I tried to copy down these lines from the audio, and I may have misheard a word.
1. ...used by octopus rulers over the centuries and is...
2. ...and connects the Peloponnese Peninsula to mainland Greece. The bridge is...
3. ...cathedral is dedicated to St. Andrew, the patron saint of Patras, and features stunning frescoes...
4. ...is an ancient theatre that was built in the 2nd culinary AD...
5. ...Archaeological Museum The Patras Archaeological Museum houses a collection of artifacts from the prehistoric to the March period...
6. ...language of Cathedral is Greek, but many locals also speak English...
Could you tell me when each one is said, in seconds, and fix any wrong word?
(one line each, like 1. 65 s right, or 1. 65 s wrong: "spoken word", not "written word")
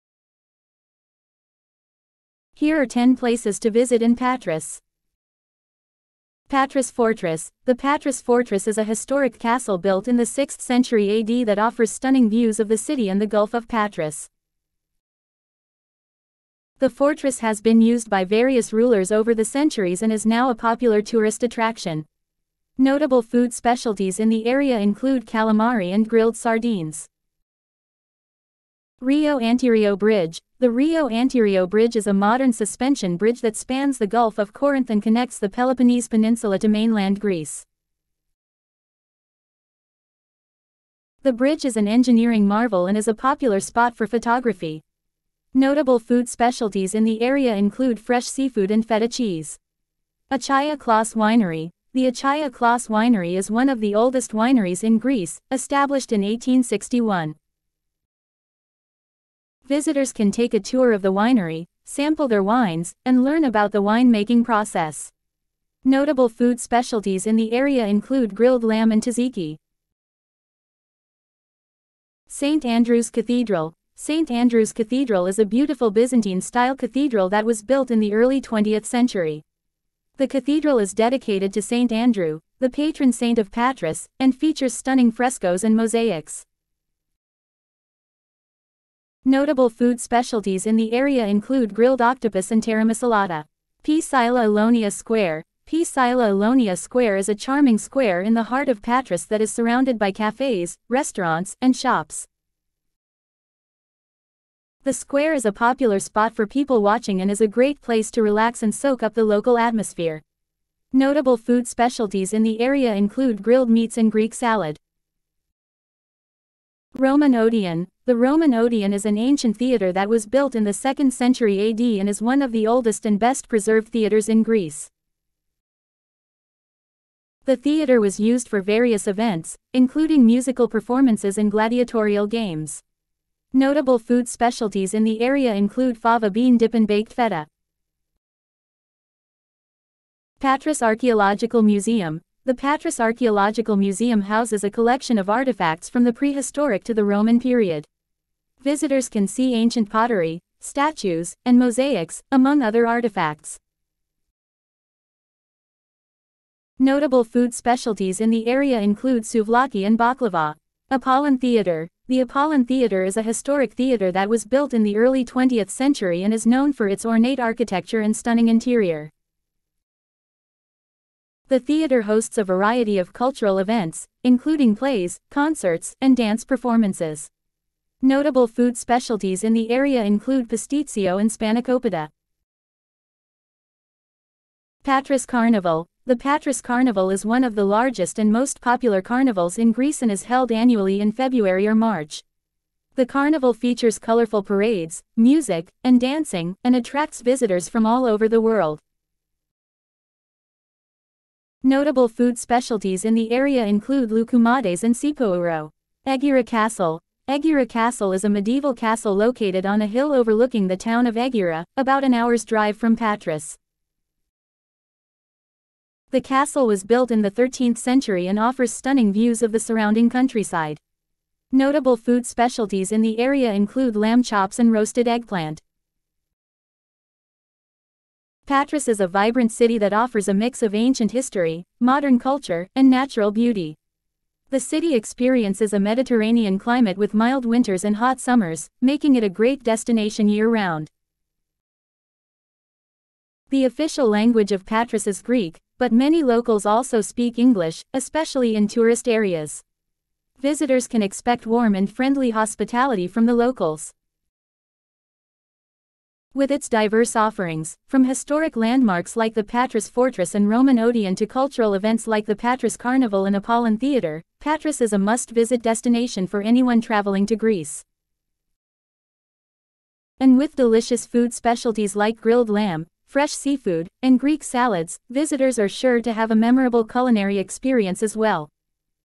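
1. 17 s wrong: "various", not "octopus"
2. 34 s right
3. 80 s right
4. 118 s wrong: "century", not "culinary"
5. 140 s wrong: "Roman", not "March"
6. 244 s wrong: "Patras", not "Cathedral".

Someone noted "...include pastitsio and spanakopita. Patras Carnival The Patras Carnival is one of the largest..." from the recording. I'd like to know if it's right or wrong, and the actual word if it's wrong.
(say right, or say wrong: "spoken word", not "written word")
right.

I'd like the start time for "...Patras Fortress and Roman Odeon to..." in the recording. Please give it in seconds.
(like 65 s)
259 s.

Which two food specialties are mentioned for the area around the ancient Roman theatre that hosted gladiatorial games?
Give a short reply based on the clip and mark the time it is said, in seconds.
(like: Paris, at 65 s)
fava bean dip and baked feta, at 135 s.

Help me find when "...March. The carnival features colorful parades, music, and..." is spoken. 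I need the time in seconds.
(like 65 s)
191 s.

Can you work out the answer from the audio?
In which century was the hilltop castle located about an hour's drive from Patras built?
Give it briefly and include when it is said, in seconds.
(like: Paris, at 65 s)
13th century, at 217 s.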